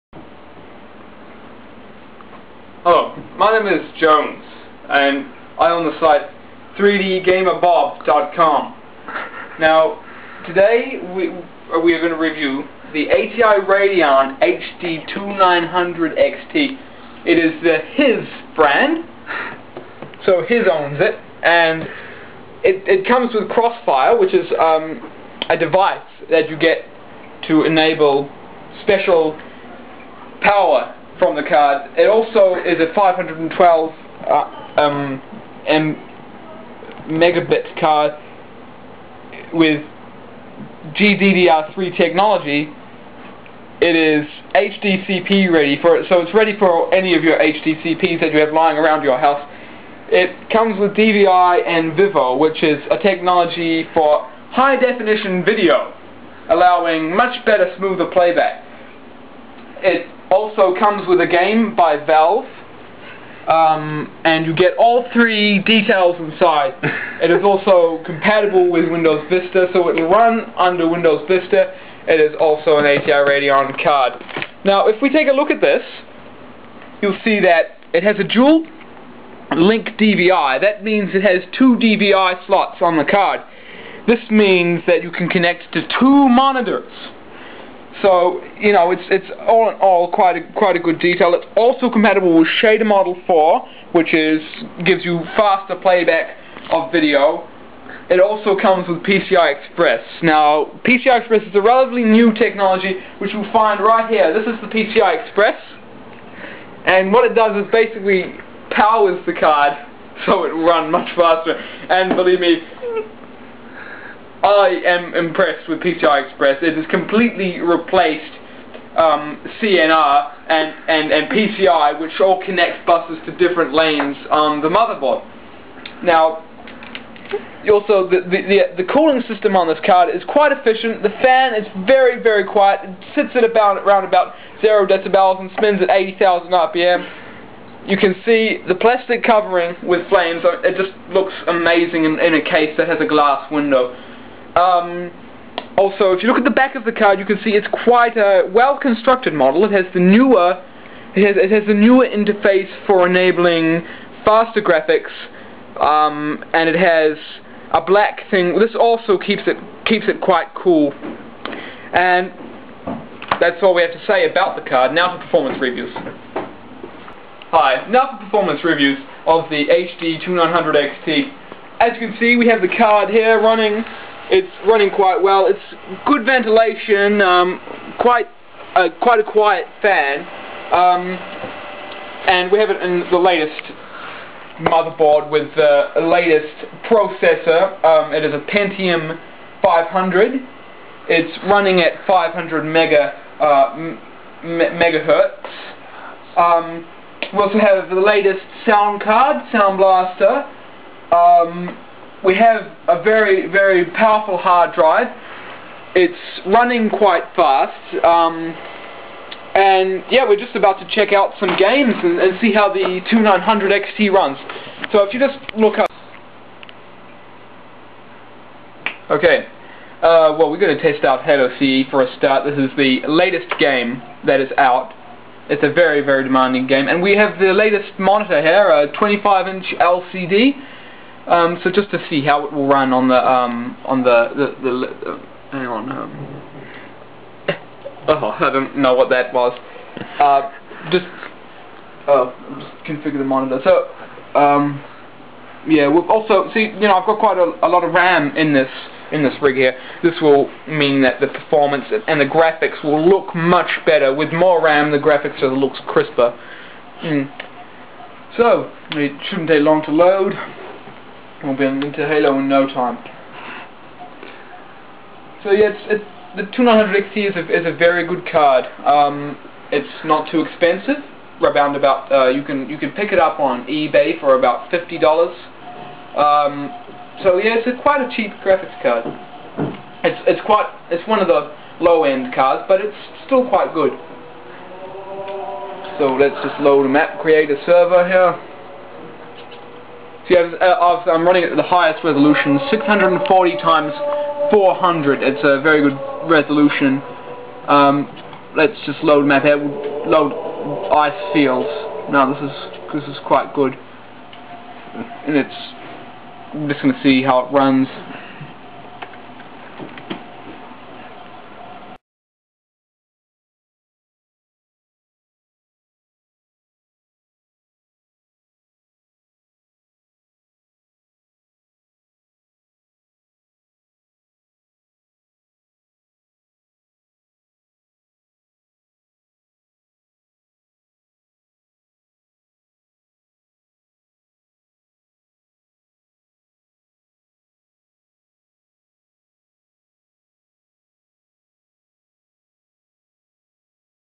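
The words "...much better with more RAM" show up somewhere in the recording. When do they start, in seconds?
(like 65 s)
253 s.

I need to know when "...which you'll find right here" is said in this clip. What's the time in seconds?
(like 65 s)
103 s.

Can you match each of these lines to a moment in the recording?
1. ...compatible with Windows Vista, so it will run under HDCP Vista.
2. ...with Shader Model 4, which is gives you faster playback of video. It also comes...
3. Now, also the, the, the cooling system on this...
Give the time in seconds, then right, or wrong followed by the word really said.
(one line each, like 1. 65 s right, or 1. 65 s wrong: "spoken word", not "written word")
1. 68 s wrong: "Windows", not "HDCP"
2. 92 s right
3. 126 s right.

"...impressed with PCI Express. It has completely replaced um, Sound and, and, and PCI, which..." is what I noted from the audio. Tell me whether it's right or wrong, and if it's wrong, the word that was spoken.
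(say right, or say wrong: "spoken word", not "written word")
wrong: "CNR", not "Sound".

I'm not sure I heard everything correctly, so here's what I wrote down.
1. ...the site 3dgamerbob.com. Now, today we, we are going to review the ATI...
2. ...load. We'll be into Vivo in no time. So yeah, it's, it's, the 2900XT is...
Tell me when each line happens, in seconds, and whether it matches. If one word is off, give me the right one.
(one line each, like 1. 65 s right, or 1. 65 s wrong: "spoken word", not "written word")
1. 5 s right
2. 259 s wrong: "Halo", not "Vivo".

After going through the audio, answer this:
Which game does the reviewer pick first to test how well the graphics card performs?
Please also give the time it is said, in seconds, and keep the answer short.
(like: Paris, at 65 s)
Halo CE, at 221 s.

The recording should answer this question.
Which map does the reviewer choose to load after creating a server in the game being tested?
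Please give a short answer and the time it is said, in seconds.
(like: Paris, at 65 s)
Ice Fields, at 300 s.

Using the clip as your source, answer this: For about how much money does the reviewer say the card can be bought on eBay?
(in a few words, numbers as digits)
$50.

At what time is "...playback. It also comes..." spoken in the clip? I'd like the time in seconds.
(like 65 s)
58 s.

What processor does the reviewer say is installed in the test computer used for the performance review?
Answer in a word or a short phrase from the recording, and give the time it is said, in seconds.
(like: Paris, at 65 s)
Pentium 500, at 188 s.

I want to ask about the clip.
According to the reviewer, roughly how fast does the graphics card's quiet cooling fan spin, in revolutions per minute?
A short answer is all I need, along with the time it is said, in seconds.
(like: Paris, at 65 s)
80,000, at 135 s.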